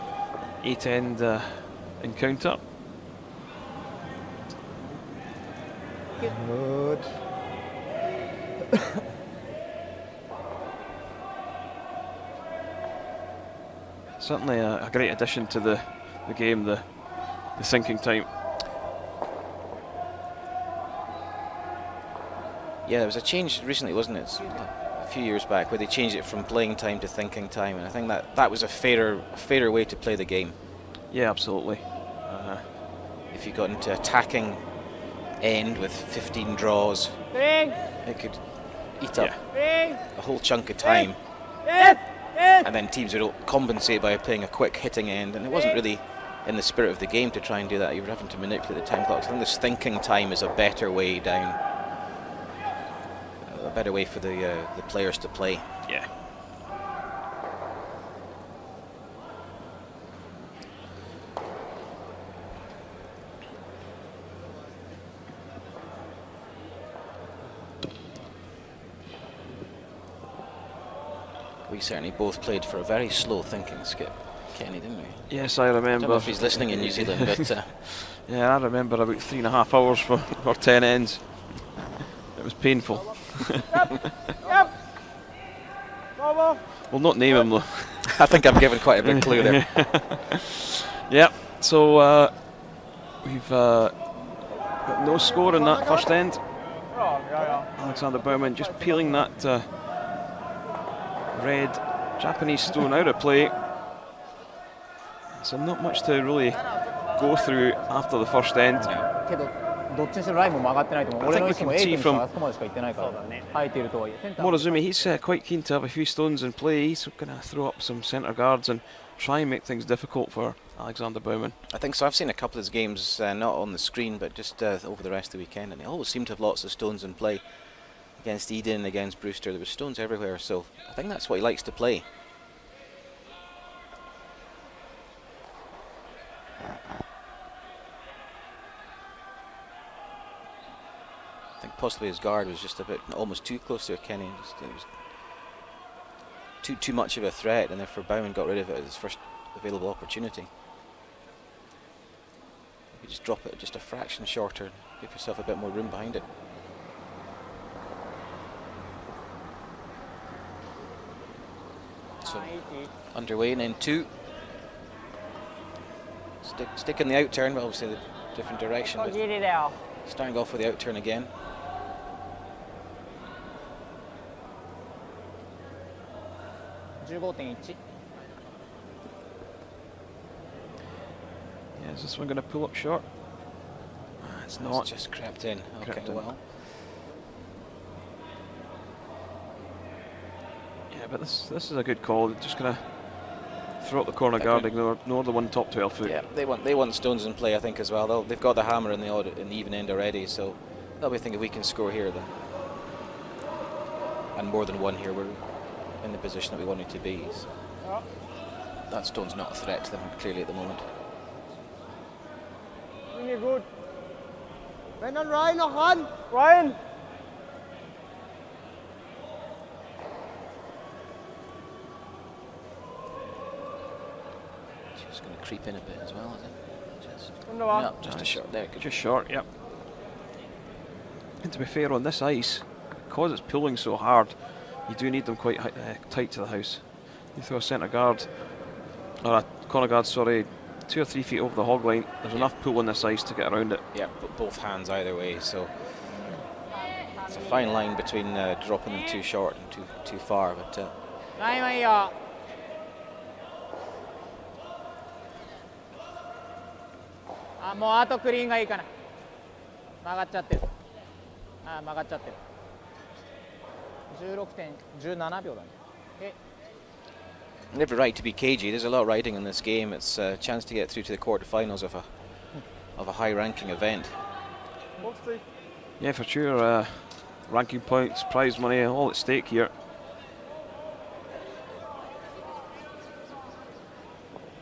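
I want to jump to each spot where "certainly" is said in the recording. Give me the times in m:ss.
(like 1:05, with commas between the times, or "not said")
0:14, 1:11.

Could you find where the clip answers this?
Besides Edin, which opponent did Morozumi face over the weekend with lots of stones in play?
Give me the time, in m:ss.
2:09.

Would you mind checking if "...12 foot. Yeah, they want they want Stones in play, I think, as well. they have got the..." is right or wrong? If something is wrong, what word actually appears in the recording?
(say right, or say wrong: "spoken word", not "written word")
right.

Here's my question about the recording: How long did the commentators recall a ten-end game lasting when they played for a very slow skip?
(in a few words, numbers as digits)
3.5 hours.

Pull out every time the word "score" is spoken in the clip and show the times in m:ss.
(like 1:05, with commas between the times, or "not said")
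1:35, 3:21.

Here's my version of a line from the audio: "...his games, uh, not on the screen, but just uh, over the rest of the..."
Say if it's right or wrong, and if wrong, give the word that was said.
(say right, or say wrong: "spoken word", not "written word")
right.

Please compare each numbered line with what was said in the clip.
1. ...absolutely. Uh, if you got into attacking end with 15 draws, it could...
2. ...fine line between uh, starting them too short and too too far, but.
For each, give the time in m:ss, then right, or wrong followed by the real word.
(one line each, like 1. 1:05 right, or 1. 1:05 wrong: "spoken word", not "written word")
1. 0:31 right
2. 4:07 wrong: "dropping", not "starting".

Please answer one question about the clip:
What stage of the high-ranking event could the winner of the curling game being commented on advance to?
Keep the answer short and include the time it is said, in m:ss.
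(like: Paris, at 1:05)
quarterfinals, at 4:31.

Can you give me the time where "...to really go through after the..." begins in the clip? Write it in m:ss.
1:46.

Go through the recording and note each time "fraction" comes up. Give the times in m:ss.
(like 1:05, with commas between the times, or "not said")
2:33.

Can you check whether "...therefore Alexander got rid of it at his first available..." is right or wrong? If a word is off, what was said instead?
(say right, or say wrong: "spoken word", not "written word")
wrong: "Baumann", not "Alexander".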